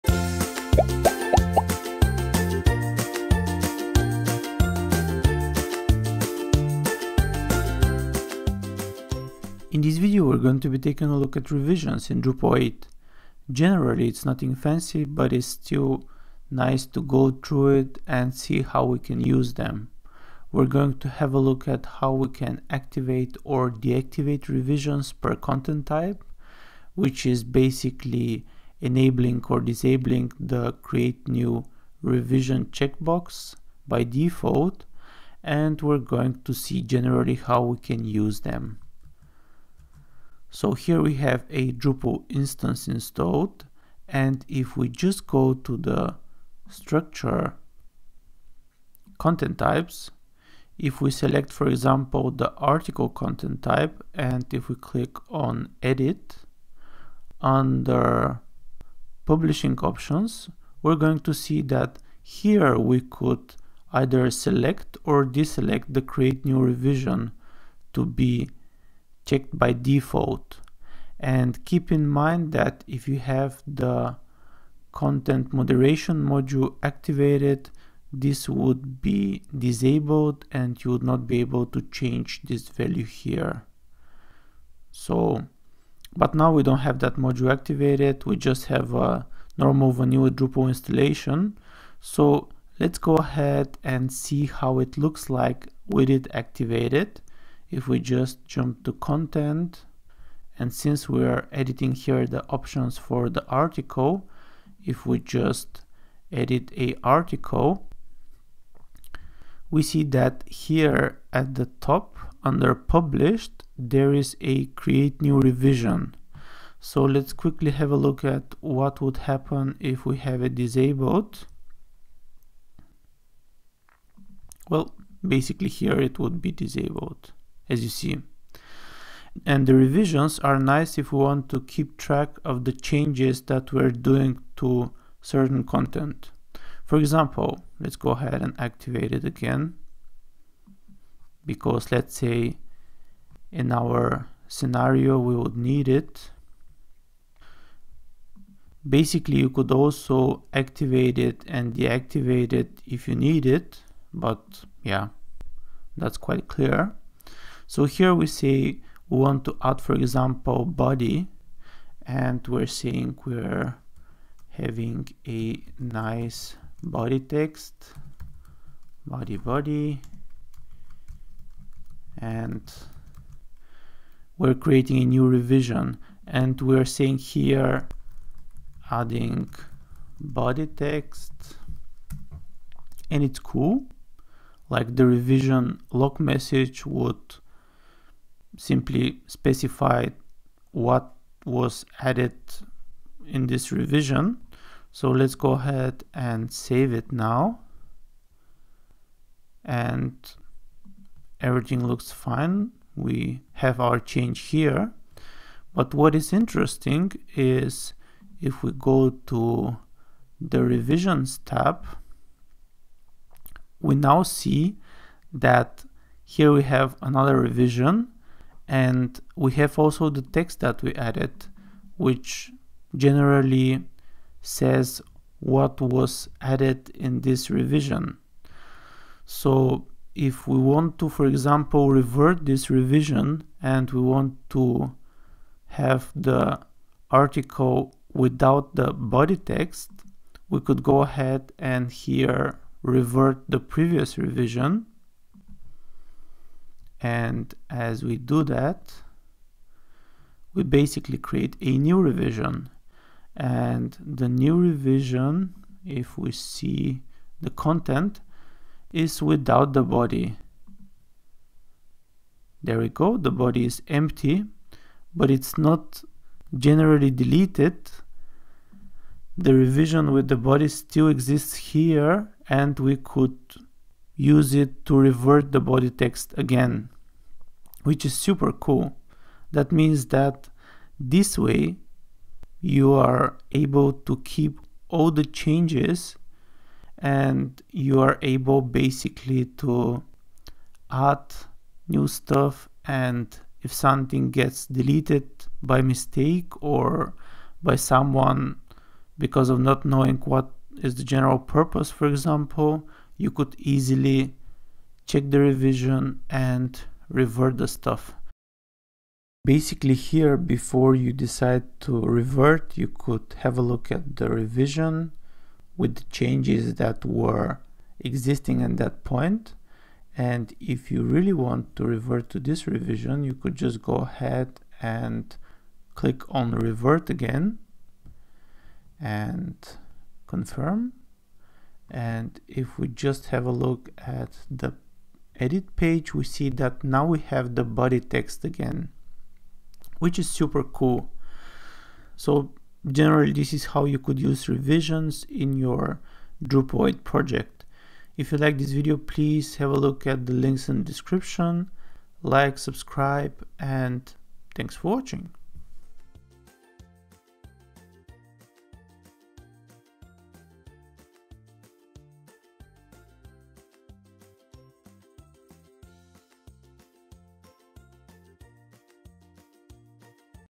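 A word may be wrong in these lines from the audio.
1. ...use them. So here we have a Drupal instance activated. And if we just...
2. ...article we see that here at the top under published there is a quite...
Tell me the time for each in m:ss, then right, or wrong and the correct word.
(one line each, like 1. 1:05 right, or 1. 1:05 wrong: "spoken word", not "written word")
1. 0:38 wrong: "installed", not "activated"
2. 1:47 wrong: "create", not "quite".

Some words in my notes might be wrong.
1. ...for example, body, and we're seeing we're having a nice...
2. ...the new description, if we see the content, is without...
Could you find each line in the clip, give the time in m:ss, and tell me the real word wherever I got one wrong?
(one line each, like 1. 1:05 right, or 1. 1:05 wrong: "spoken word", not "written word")
1. 2:39 right
2. 4:13 wrong: "revision", not "description".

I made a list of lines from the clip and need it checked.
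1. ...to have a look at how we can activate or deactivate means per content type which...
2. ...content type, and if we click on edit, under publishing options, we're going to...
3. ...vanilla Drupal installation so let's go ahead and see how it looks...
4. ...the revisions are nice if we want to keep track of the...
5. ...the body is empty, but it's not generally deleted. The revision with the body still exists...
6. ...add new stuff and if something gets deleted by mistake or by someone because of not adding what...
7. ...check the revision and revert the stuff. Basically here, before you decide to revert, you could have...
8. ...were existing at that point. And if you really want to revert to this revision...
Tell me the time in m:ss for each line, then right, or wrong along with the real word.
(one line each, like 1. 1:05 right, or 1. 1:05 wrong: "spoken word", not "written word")
1. 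0:20 wrong: "revisions", not "means"
2. 0:53 right
3. 1:29 right
4. 2:09 right
5. 4:23 right
6. 4:50 wrong: "knowing", not "adding"
7. 5:05 right
8. 5:17 right.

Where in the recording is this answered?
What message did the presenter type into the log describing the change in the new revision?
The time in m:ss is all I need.
2:58.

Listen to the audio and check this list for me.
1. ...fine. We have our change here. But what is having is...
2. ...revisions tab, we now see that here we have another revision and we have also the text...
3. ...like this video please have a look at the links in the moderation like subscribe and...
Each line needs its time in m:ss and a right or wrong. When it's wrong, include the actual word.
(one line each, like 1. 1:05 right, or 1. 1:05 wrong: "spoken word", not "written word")
1. 3:22 wrong: "interesting", not "having"
2. 3:30 right
3. 5:48 wrong: "description", not "moderation".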